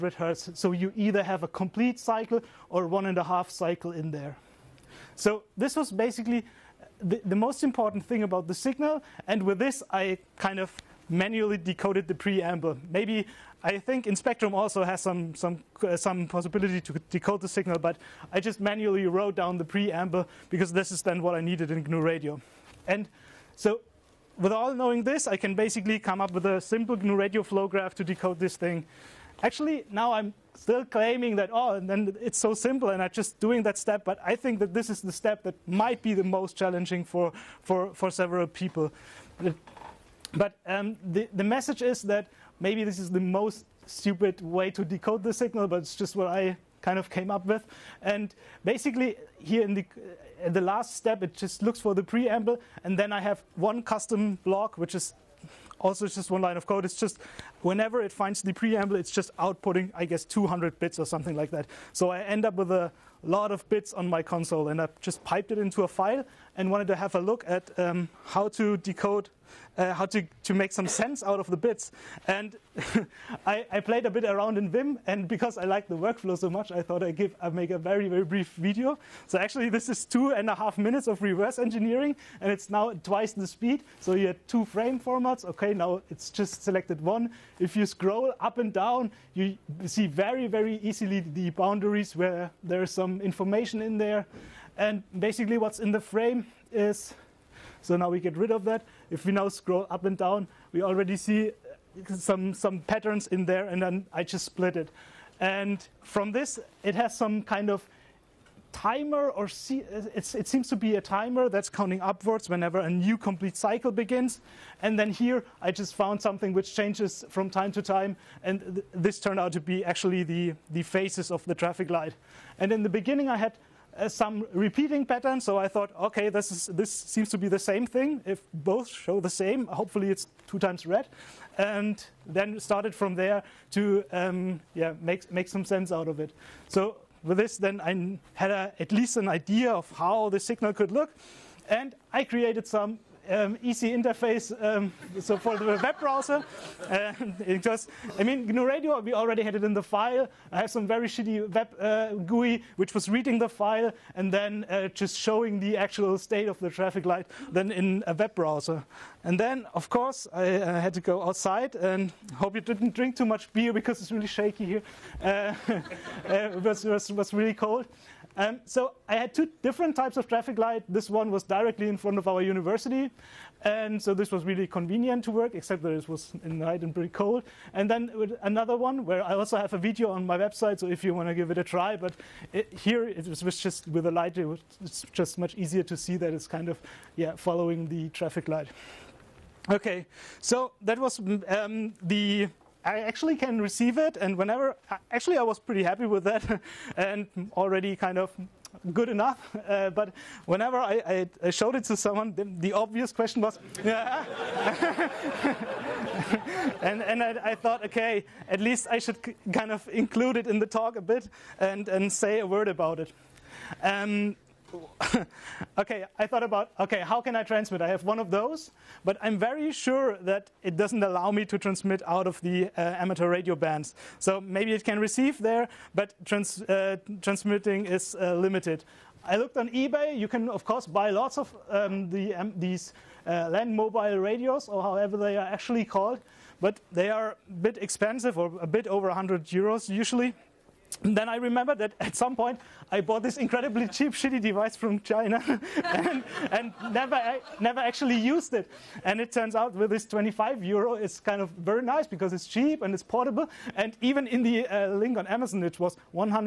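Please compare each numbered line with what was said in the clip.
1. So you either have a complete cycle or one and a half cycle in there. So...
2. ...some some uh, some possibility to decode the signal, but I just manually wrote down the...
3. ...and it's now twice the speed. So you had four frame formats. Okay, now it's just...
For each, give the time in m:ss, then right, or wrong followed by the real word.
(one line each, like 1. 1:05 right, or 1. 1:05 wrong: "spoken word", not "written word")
1. 0:00 right
2. 0:15 right
3. 1:22 wrong: "two", not "four".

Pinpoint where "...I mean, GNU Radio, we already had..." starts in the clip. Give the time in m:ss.
2:28.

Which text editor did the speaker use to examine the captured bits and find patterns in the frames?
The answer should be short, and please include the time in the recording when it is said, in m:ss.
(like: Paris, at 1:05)
Vim, at 1:14.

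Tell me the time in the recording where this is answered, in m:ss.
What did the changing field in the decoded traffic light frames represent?
2:00.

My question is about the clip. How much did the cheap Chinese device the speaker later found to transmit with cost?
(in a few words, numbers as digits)
25 euros.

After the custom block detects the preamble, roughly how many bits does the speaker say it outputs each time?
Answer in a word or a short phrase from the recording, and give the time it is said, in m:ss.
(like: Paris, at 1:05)
200, at 1:00.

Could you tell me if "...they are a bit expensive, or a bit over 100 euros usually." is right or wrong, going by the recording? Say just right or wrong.
right.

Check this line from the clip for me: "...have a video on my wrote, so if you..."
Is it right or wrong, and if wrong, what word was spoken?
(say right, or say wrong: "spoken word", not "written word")
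wrong: "website", not "wrote".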